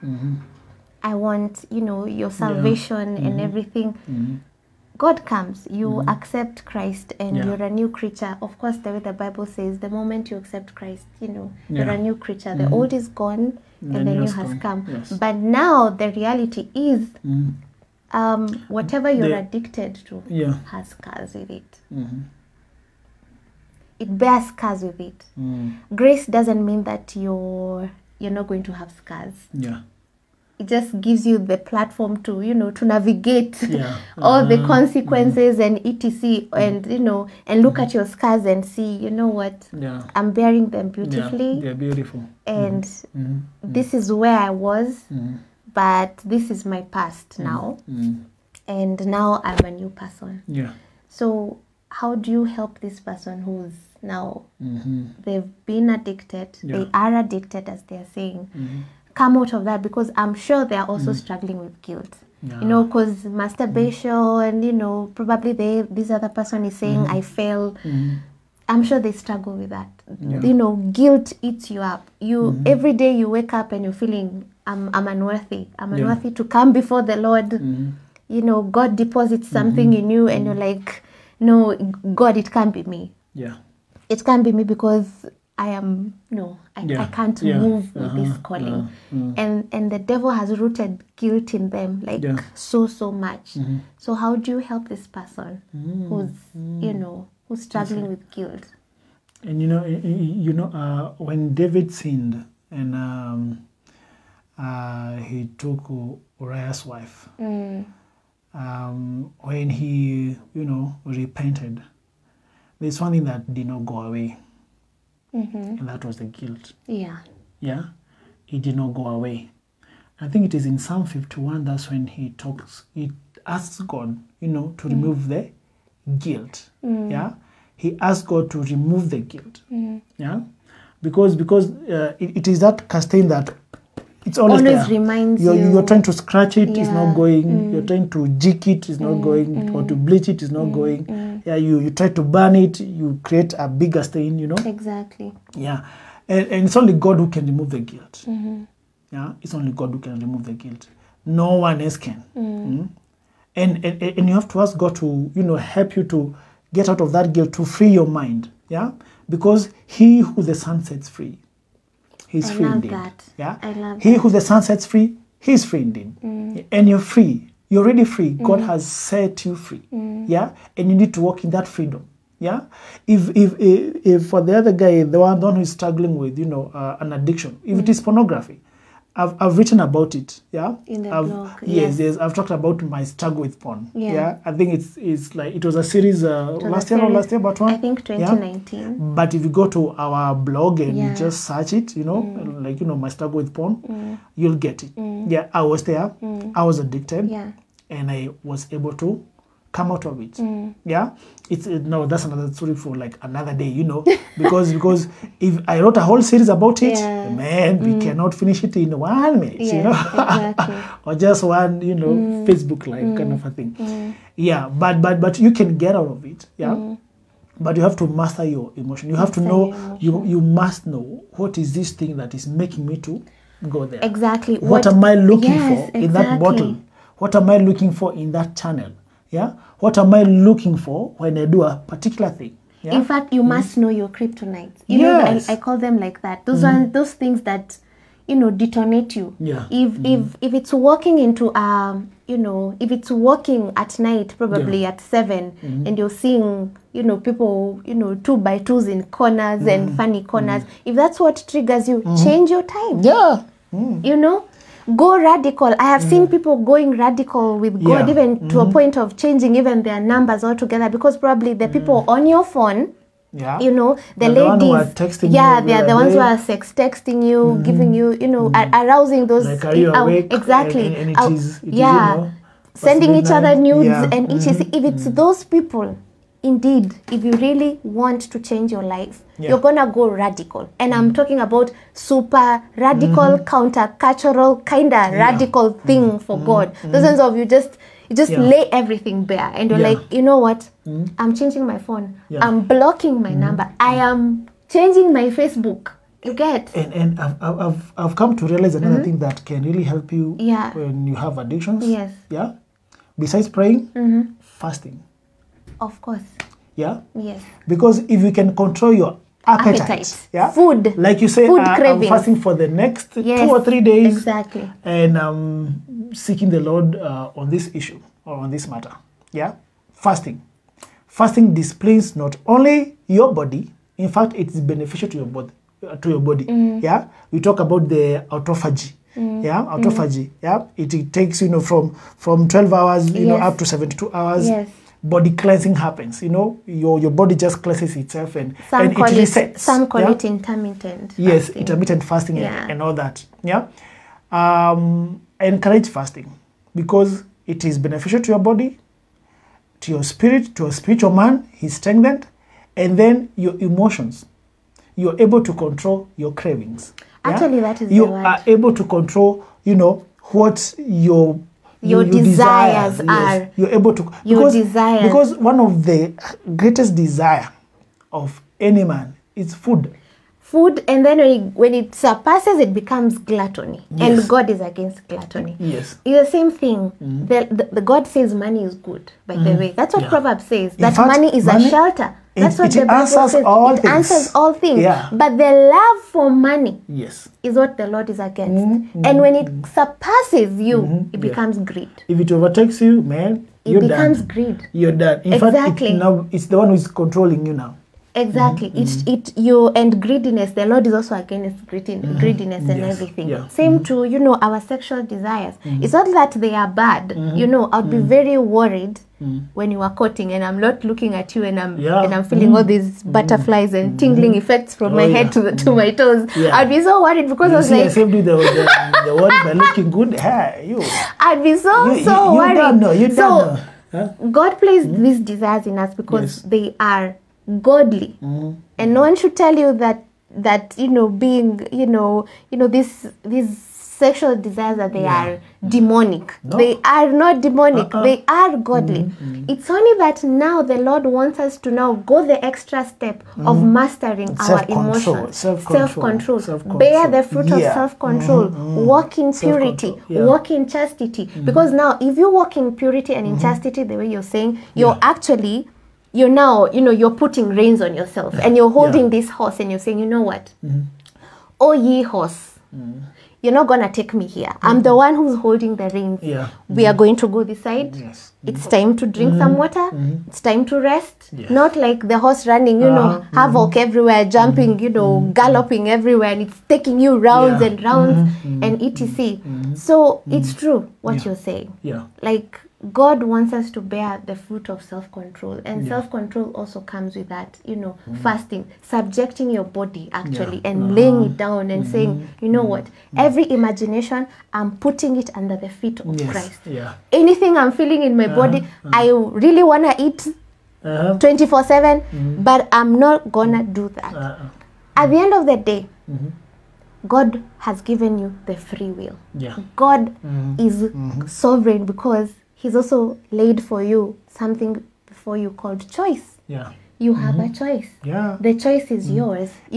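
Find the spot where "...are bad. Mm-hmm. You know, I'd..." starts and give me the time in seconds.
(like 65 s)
406 s.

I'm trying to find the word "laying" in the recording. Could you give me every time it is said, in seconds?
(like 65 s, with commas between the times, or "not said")
490 s.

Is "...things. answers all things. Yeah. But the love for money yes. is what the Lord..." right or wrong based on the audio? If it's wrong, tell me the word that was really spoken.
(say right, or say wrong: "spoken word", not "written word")
right.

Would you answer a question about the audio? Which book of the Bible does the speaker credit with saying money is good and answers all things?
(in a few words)
Proverbs.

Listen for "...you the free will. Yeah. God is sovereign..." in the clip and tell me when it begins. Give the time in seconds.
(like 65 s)
508 s.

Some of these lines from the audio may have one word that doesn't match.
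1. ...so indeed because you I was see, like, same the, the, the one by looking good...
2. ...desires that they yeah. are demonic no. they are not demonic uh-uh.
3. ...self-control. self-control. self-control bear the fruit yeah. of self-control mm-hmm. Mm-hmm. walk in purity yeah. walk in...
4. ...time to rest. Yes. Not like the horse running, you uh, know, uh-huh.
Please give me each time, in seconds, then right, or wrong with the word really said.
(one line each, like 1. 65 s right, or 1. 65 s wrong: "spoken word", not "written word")
1. 416 s wrong: "worried", not "indeed"
2. 434 s right
3. 445 s right
4. 470 s right.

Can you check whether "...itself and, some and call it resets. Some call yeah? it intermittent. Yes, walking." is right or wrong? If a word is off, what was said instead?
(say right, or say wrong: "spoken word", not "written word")
wrong: "fasting", not "walking".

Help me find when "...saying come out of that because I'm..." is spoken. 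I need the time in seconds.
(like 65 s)
58 s.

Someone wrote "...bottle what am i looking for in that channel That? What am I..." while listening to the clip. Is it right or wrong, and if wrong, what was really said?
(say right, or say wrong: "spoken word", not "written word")
wrong: "Yeah", not "That".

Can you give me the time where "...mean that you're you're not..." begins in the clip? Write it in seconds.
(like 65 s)
26 s.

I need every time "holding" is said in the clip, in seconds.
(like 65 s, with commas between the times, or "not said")
458 s, 465 s.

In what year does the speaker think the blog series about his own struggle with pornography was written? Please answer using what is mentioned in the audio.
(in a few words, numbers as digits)
2019.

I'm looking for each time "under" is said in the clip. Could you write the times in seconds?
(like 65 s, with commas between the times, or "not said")
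495 s.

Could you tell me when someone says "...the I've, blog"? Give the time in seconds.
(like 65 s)
181 s.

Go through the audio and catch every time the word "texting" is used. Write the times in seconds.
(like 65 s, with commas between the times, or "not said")
266 s.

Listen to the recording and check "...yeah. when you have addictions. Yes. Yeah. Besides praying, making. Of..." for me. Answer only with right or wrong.
wrong.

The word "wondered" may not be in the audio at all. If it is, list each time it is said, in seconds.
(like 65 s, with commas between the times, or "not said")
not said.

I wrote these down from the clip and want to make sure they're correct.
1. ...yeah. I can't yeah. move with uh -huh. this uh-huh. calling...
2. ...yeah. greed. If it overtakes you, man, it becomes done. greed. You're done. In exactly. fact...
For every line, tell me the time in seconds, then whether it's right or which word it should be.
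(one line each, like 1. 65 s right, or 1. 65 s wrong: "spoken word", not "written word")
1. 86 s right
2. 391 s right.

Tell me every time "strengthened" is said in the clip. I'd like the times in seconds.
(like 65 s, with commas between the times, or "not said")
351 s.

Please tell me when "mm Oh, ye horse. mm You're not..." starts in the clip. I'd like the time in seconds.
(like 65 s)
460 s.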